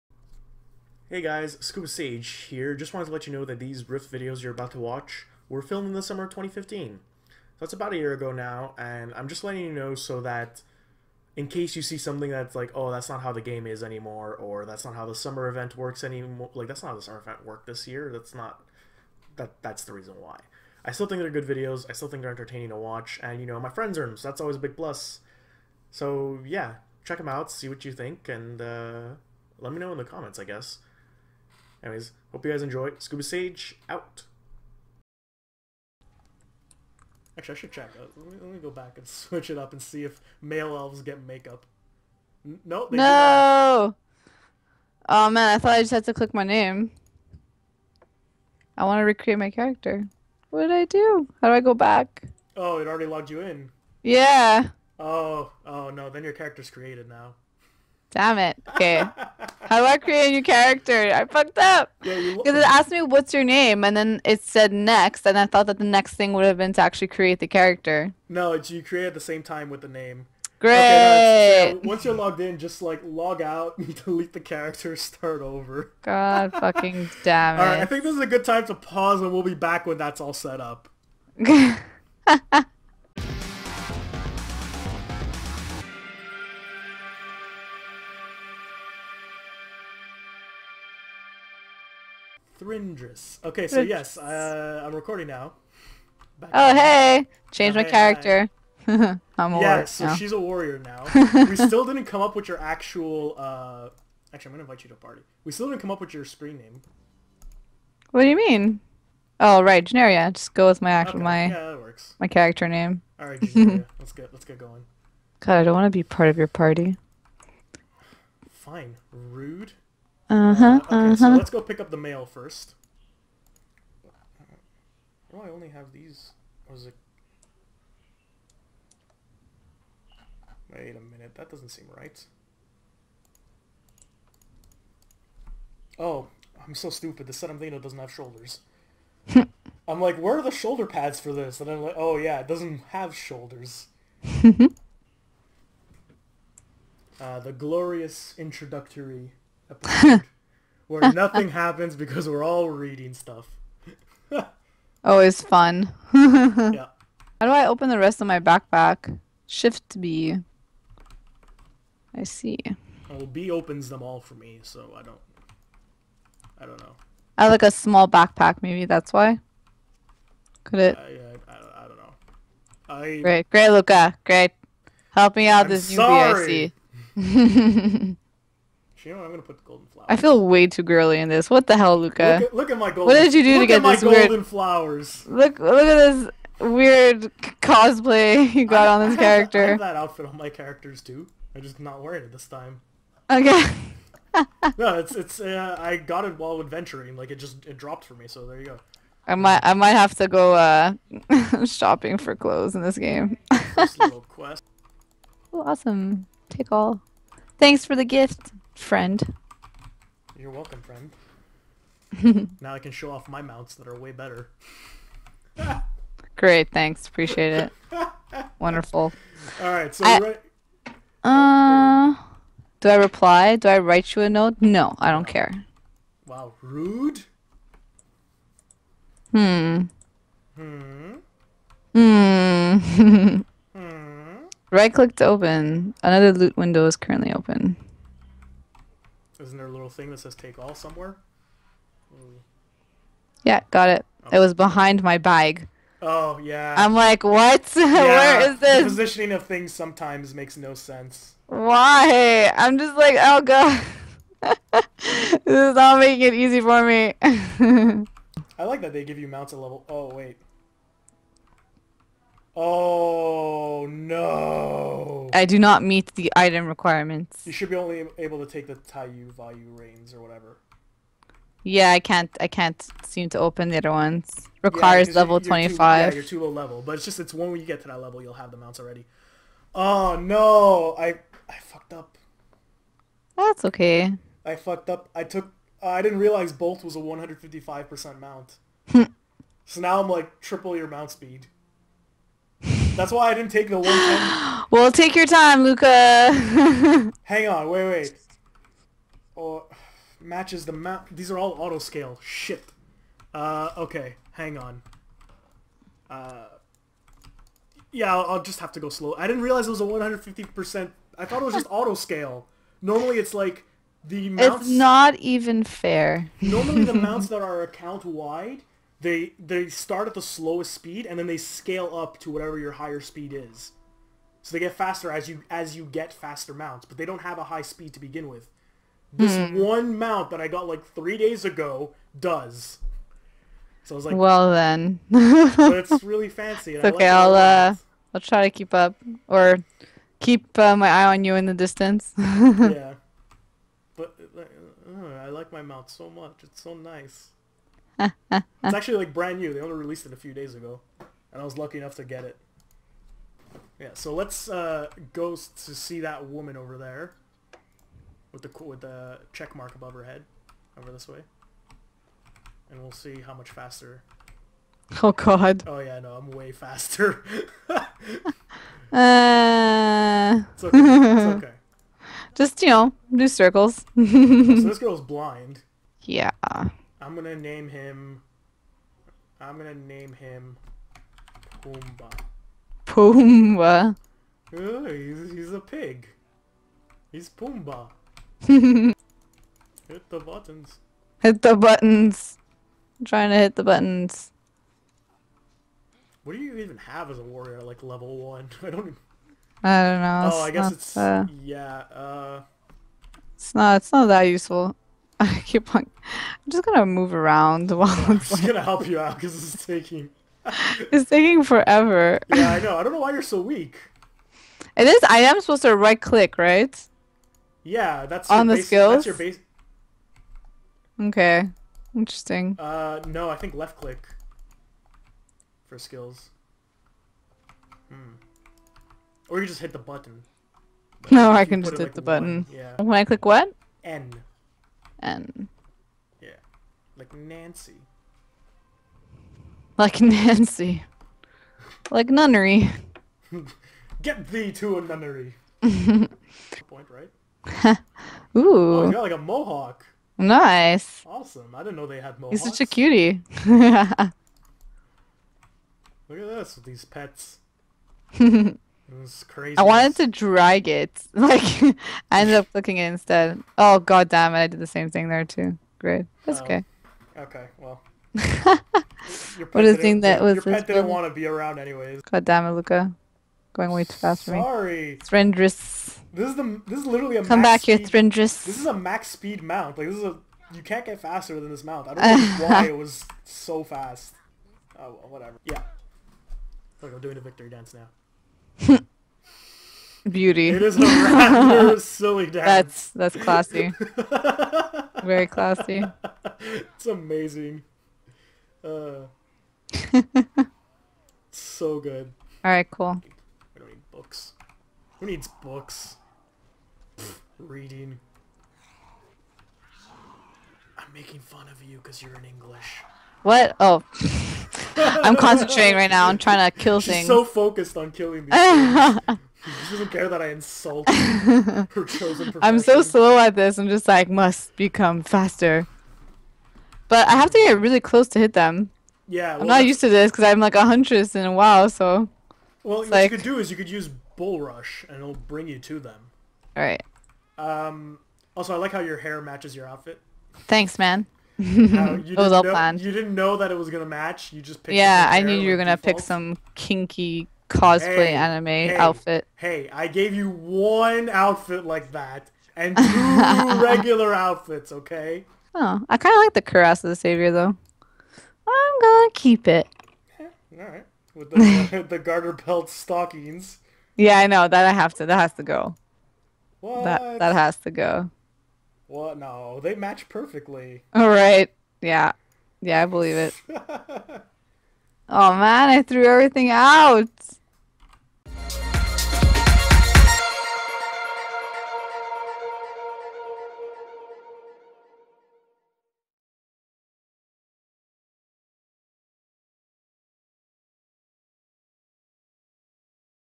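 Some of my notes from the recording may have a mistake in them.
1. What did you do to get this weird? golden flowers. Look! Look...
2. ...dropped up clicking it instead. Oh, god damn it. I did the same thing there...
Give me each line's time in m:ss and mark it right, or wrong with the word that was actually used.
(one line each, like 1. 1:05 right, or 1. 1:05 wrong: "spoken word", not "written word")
1. 3:03 right
2. 7:42 wrong: "ended", not "dropped".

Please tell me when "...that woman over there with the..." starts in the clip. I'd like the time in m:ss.
5:56.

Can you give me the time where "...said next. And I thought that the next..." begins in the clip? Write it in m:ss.
1:04.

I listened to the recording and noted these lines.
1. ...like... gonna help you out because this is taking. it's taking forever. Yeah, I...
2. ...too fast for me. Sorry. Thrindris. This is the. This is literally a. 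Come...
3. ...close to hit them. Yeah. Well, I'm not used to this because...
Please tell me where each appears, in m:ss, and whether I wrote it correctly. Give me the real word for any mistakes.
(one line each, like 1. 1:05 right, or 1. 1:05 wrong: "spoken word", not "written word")
1. 6:48 right
2. 7:53 right
3. 8:47 right.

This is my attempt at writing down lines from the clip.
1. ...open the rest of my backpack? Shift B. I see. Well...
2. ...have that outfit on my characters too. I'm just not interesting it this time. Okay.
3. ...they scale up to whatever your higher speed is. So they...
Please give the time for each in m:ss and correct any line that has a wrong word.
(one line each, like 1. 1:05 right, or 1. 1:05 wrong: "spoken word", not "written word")
1. 2:37 right
2. 3:09 wrong: "wearing", not "interesting"
3. 5:21 right.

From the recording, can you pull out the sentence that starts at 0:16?
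Like, that's not how the summer event worked this year.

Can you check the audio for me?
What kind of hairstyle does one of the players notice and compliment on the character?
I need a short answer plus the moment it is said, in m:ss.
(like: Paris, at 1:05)
a mohawk, at 7:29.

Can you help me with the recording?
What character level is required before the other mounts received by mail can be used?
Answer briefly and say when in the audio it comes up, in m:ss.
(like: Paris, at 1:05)
25, at 4:35.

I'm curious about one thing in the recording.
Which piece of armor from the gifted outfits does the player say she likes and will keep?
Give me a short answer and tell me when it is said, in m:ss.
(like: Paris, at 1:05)
cuirass of the savior, at 9:16.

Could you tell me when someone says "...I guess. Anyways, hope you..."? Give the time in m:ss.
0:30.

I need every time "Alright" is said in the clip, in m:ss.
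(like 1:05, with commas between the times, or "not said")
1:53, 8:56.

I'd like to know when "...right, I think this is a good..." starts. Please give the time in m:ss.
1:17.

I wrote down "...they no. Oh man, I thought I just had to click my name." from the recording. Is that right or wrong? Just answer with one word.
right.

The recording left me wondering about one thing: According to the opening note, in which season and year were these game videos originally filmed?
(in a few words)
summer of 2015.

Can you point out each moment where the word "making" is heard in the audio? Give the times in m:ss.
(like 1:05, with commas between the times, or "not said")
4:15, 8:30.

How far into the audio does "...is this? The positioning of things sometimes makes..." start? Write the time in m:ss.
4:08.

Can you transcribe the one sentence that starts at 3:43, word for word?
Do I write you a note?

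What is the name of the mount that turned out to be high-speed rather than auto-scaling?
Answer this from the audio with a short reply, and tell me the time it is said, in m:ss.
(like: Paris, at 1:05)
Bolt, at 4:46.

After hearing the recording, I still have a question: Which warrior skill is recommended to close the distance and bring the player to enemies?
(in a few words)
Bull Rush.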